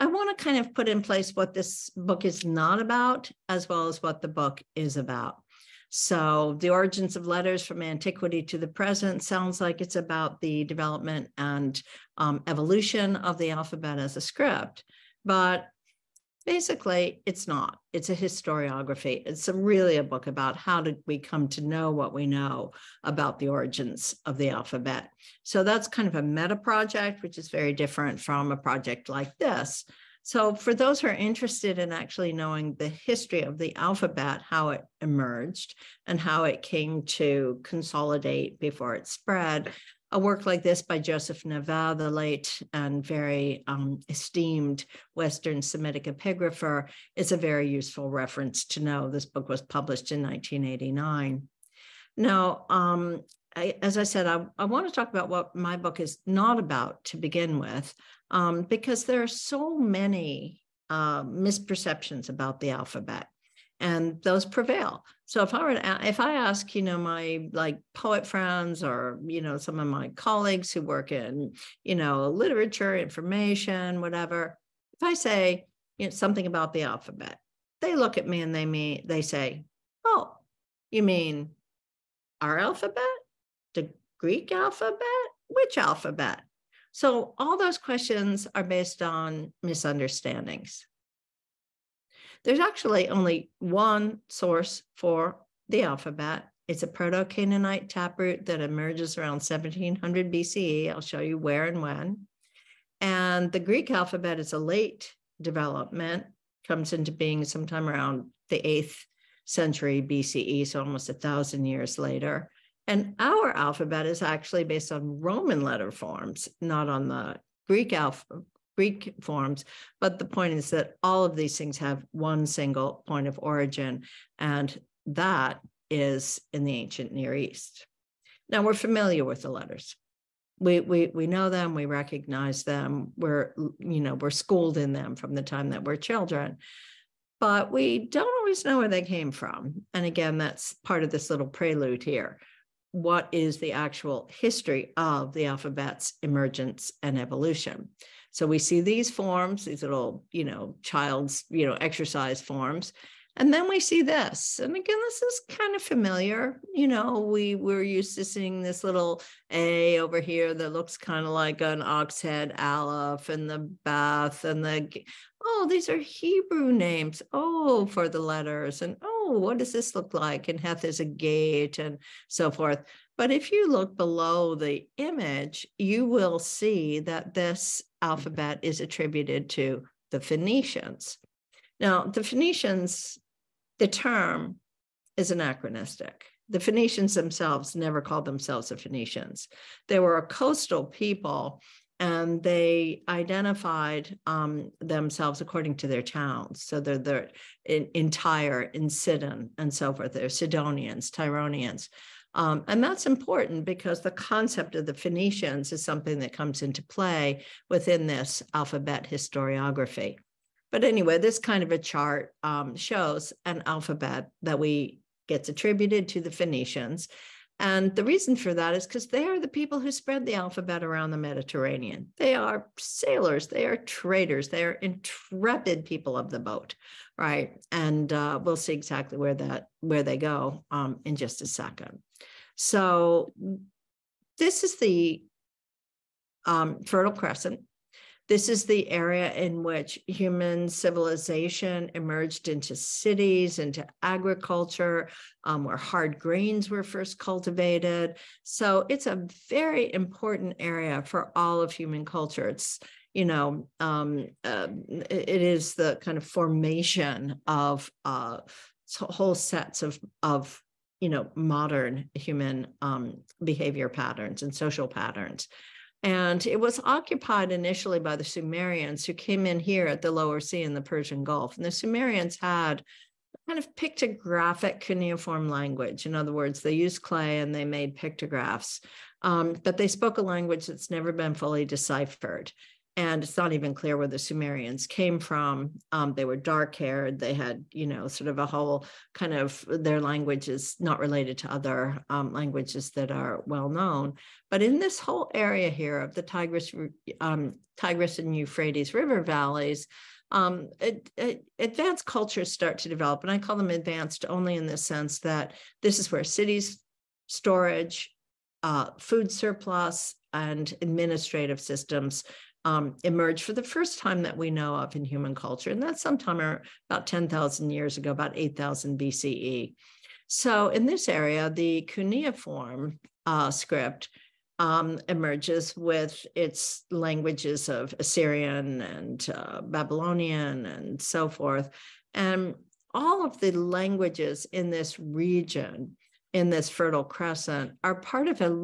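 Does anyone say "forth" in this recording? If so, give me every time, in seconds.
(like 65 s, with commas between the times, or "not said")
172 s, 199 s, 331 s.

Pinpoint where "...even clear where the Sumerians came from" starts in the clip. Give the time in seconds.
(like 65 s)
283 s.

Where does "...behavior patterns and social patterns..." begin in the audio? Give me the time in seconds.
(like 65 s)
263 s.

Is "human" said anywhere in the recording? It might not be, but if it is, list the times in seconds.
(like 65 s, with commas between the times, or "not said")
240 s, 251 s, 262 s, 315 s.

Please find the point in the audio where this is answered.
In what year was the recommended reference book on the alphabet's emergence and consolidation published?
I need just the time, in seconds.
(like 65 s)
50 s.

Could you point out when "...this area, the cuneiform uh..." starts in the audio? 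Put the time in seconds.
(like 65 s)
320 s.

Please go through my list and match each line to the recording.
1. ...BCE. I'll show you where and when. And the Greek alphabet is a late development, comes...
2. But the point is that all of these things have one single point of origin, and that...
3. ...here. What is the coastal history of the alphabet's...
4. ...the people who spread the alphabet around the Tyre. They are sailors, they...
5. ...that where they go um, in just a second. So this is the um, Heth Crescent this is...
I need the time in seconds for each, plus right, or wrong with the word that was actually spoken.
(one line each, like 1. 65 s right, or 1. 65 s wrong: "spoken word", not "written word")
1. 100 s right
2. 119 s right
3. 142 s wrong: "actual", not "coastal"
4. 219 s wrong: "Mediterranean", not "Tyre"
5. 229 s wrong: "Fertile", not "Heth".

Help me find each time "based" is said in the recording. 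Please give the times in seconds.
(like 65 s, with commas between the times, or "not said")
88 s, 114 s.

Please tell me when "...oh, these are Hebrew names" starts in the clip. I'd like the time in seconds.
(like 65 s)
165 s.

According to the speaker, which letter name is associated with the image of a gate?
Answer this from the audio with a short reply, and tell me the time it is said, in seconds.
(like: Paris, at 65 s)
Heth, at 170 s.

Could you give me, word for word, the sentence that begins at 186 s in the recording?
The Phoenicians themselves never called themselves the Phoenicians.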